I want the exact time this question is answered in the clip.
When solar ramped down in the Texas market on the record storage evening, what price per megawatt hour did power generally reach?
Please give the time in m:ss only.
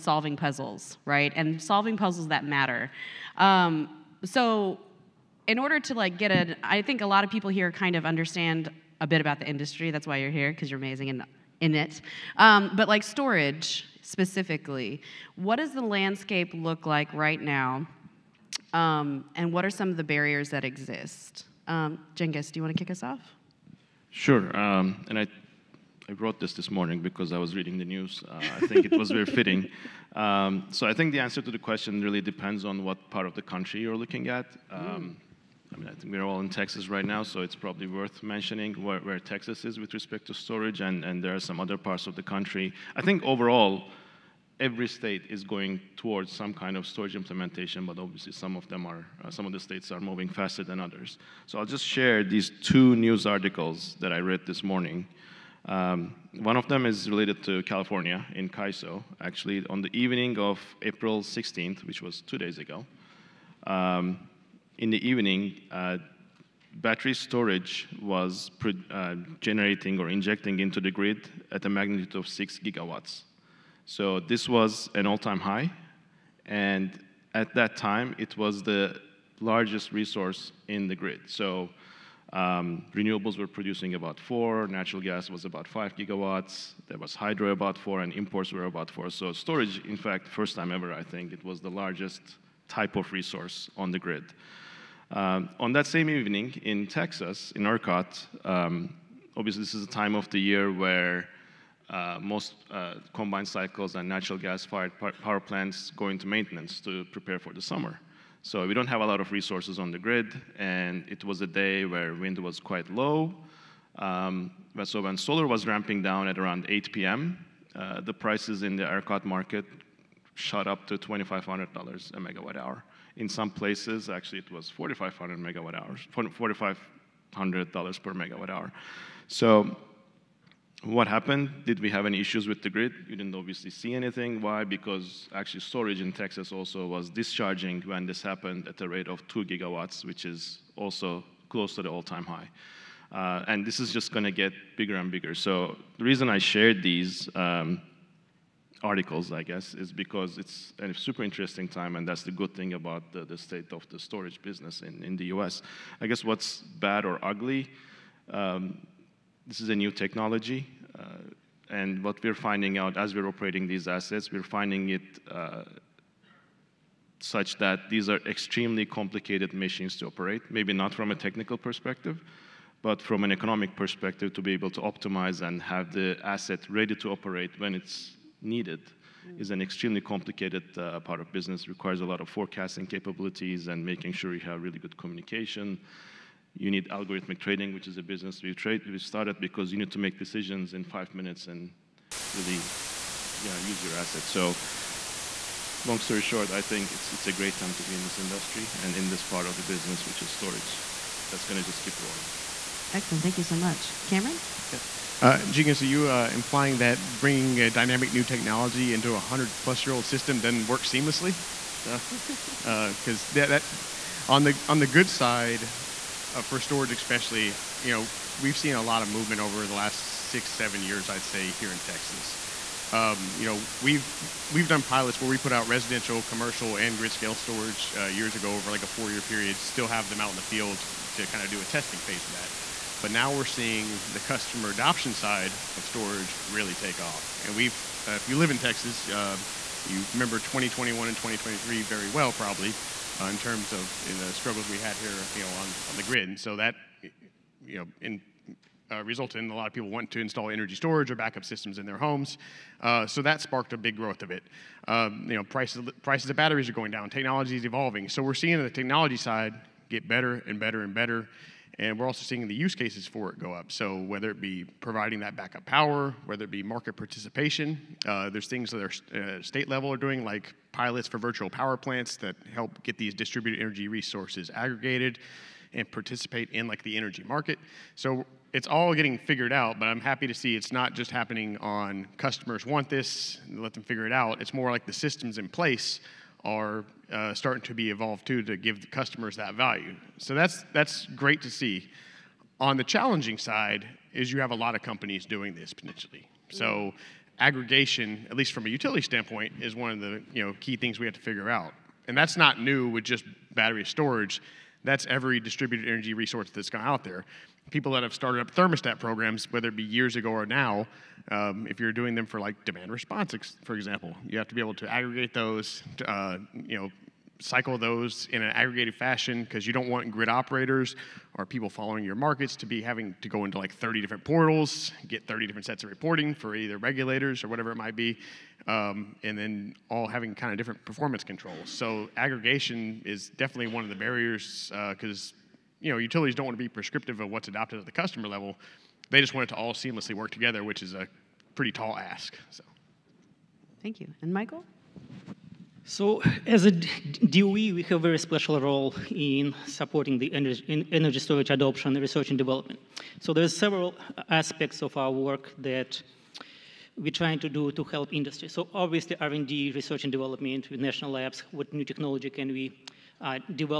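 2:00.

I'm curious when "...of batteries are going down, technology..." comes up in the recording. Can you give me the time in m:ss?
4:16.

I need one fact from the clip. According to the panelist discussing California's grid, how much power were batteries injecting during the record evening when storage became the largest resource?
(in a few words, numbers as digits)
6 gigawatts.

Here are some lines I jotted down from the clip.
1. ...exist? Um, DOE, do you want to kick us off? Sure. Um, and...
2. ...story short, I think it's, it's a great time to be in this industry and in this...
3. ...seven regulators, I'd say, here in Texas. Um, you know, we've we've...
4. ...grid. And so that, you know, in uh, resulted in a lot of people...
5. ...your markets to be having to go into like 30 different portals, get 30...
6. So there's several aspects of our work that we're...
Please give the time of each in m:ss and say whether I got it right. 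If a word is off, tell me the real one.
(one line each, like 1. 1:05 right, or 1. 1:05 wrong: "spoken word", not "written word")
1. 0:20 wrong: "Cengiz", not "DOE"
2. 3:15 right
3. 3:40 wrong: "years", not "regulators"
4. 4:06 right
5. 5:22 right
6. 5:53 right.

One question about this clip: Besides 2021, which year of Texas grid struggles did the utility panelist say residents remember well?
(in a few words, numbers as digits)
2023.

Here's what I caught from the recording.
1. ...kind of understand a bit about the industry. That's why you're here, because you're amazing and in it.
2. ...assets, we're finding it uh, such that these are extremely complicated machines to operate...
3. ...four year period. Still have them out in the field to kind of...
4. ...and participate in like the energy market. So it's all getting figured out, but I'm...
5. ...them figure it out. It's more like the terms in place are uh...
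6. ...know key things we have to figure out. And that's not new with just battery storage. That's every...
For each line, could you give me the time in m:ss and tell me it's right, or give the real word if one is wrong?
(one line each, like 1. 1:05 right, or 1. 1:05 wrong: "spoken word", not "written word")
1. 0:07 right
2. 2:43 right
3. 3:48 right
4. 4:35 right
5. 4:43 wrong: "systems", not "terms"
6. 5:00 right.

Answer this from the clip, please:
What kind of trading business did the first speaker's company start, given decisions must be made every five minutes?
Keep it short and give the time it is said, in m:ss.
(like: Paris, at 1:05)
Algorithmic trading, at 3:06.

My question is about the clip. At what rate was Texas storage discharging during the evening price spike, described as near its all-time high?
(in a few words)
2 gigawatts.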